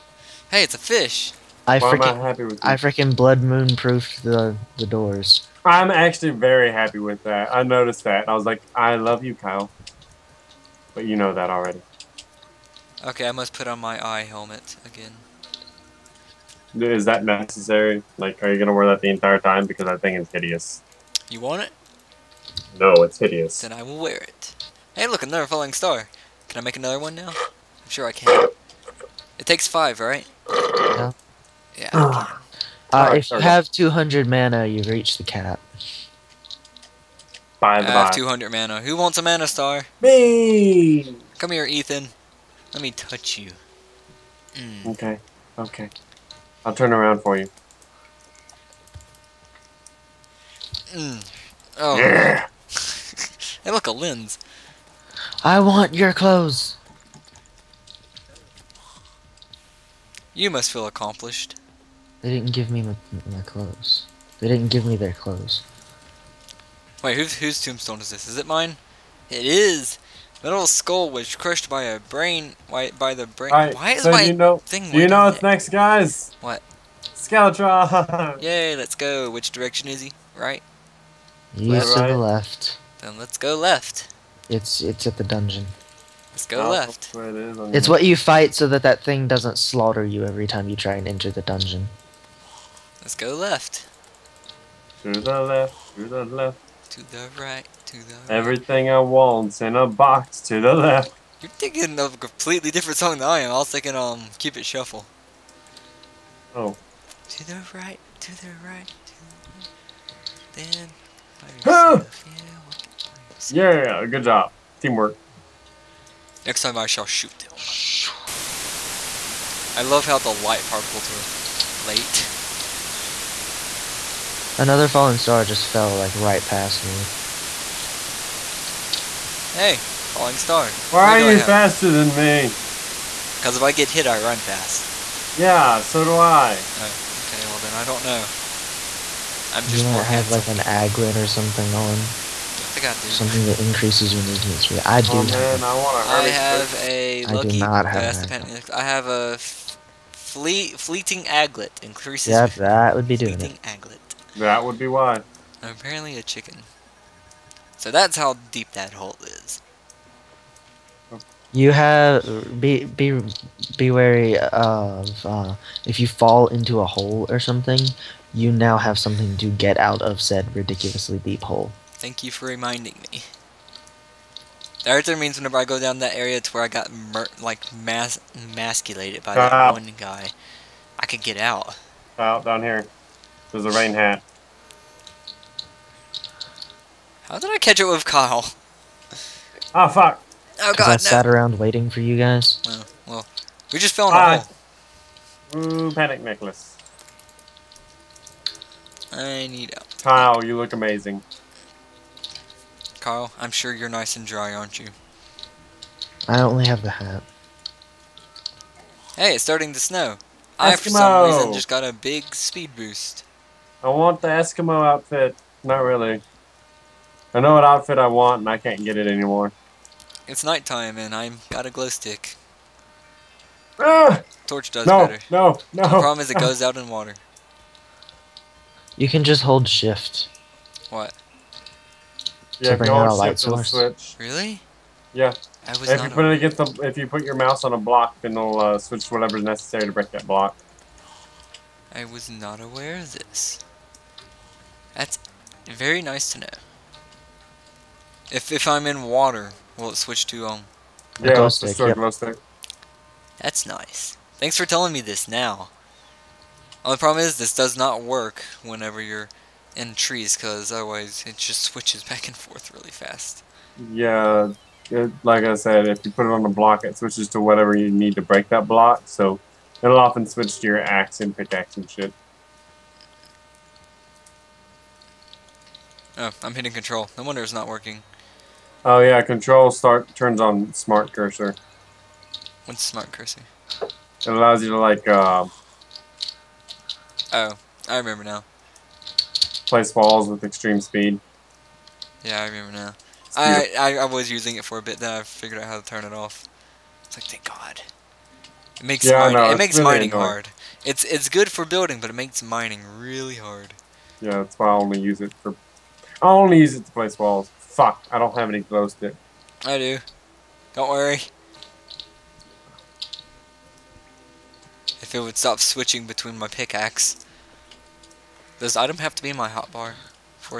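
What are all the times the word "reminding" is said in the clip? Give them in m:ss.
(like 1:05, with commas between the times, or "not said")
2:52.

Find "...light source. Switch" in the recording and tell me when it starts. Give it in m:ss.
3:53.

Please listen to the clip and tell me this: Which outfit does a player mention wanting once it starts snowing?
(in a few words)
Eskimo outfit.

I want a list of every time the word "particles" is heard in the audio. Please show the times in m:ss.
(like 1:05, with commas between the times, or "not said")
2:00.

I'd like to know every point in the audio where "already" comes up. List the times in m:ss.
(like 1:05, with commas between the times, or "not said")
0:11.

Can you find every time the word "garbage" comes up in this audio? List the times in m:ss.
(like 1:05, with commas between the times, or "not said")
not said.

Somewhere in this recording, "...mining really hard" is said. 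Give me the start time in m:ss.
5:02.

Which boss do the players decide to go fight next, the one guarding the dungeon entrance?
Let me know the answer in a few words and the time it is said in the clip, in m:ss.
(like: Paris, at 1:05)
Skeletron, at 1:17.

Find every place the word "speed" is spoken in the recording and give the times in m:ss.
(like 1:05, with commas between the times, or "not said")
2:24, 3:32, 4:50.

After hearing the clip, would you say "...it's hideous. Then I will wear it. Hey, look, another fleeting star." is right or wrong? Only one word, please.
wrong.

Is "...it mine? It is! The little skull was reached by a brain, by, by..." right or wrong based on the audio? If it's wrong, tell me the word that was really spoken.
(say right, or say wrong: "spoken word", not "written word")
wrong: "crushed", not "reached".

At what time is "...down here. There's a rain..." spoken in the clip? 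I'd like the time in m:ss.
3:02.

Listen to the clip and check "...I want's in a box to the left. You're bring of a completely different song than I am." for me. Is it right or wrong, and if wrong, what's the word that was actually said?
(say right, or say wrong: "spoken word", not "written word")
wrong: "thinking", not "bring".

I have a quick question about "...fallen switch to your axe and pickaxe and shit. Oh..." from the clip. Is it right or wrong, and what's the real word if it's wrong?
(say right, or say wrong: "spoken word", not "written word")
wrong: "often", not "fallen".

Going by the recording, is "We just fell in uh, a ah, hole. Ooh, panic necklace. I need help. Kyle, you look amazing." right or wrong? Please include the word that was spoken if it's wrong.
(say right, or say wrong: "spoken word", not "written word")
right.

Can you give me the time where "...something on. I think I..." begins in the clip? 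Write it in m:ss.
2:21.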